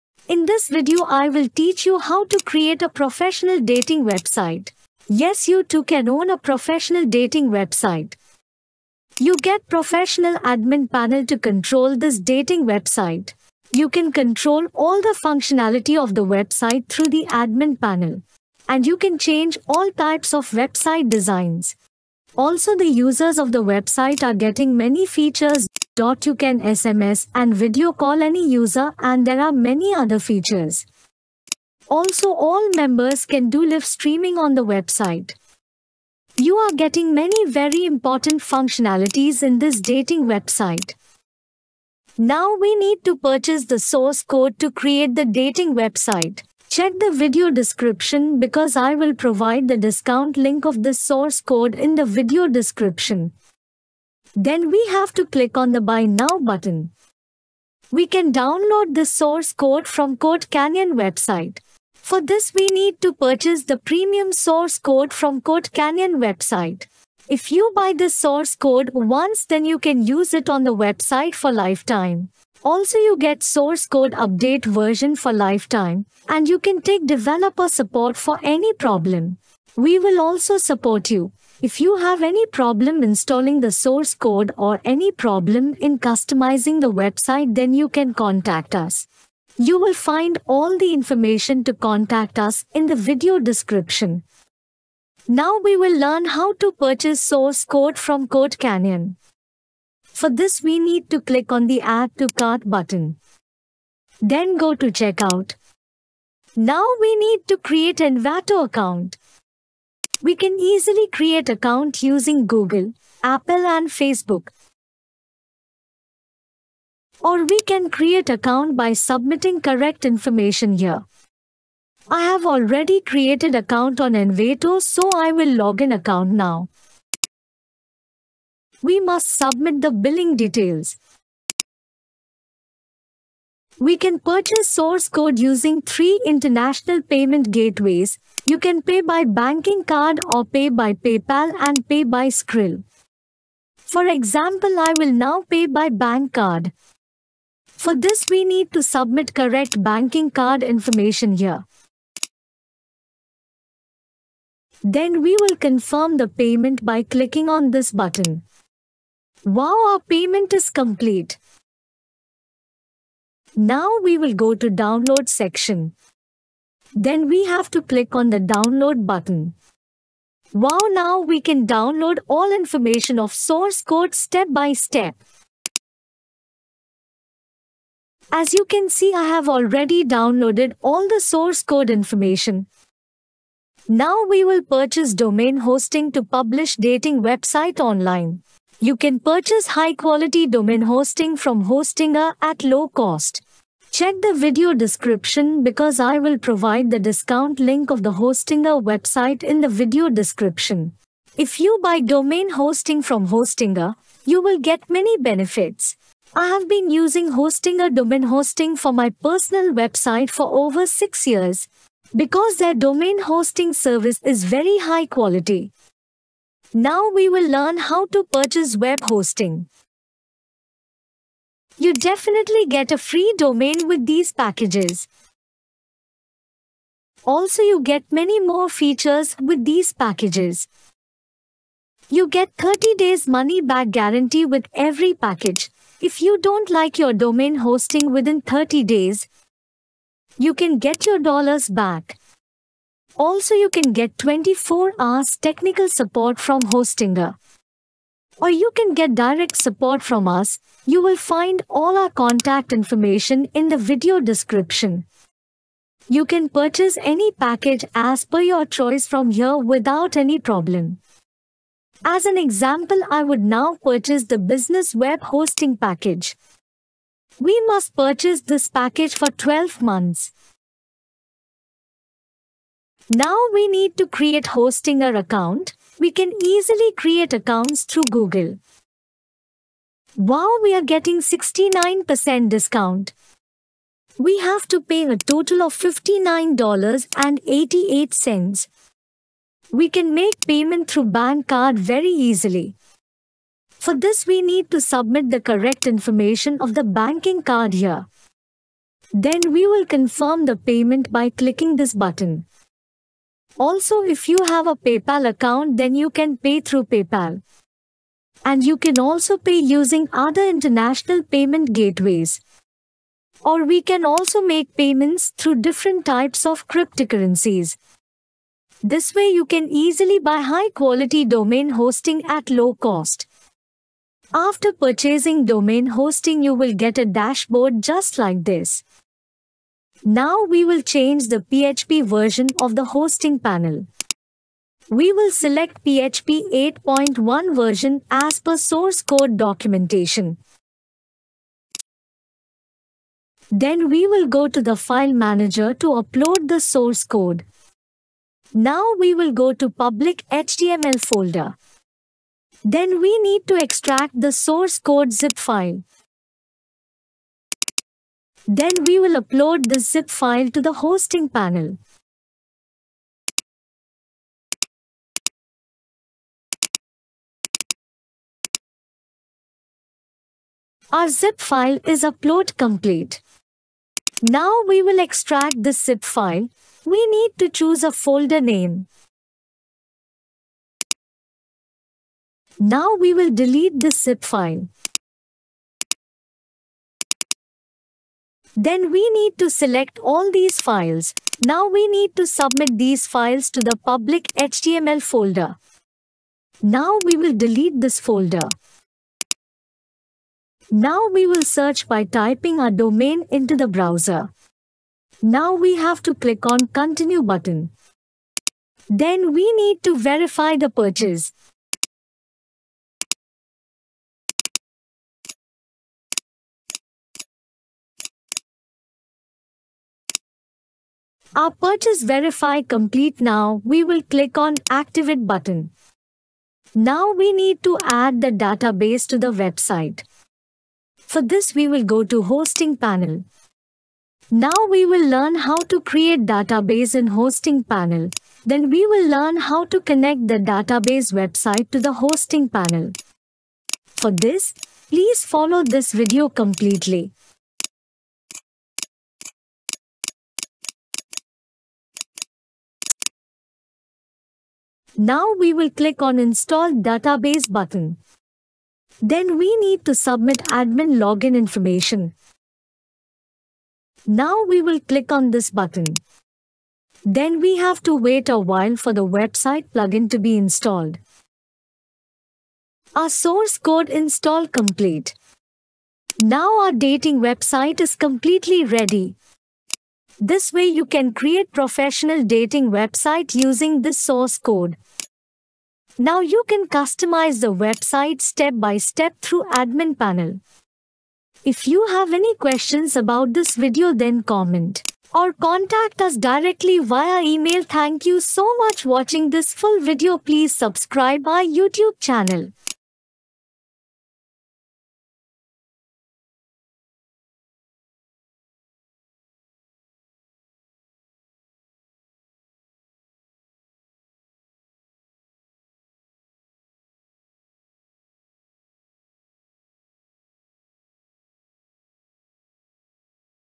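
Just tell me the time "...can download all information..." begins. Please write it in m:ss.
2:51.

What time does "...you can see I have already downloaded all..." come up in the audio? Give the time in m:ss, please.
2:58.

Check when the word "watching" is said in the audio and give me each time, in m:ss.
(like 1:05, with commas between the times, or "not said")
8:18.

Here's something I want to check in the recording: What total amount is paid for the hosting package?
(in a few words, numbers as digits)
$59.88.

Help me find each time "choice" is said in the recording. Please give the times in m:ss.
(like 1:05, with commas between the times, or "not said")
4:18.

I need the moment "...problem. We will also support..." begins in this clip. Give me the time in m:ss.
1:18.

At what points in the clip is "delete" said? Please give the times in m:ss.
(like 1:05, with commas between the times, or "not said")
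6:23, 6:37.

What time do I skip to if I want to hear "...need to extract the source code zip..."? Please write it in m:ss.
5:53.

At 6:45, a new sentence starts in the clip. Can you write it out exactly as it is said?
Now we have to click on continue button.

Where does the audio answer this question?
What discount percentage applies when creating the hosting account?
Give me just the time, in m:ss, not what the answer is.
4:41.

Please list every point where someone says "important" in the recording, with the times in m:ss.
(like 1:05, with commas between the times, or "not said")
0:37.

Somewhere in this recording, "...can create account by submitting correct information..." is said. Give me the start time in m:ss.
1:57.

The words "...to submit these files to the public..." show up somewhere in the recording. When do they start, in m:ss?
6:32.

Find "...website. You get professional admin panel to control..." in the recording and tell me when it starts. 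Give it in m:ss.
0:07.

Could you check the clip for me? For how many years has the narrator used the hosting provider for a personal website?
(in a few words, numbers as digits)
6.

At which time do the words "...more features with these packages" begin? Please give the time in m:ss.
3:48.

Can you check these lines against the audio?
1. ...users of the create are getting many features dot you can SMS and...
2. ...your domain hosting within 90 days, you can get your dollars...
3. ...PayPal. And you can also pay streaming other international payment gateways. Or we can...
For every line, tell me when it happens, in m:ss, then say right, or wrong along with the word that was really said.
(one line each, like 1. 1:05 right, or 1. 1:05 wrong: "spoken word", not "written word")
1. 0:23 wrong: "website", not "create"
2. 3:56 wrong: "30", not "90"
3. 5:06 wrong: "using", not "streaming".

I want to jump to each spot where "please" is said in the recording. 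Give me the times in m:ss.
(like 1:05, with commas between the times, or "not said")
7:24, 8:20.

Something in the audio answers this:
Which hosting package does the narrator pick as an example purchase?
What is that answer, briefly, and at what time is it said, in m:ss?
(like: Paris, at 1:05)
business web hosting, at 4:24.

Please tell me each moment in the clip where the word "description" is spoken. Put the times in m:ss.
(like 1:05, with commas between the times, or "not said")
0:47, 0:52, 1:33, 3:14, 3:20, 4:14.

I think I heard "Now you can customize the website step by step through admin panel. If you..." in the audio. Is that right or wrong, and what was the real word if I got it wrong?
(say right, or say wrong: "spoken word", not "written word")
right.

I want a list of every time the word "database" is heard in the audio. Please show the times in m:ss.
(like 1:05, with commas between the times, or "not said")
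7:08, 7:16, 7:20, 7:36.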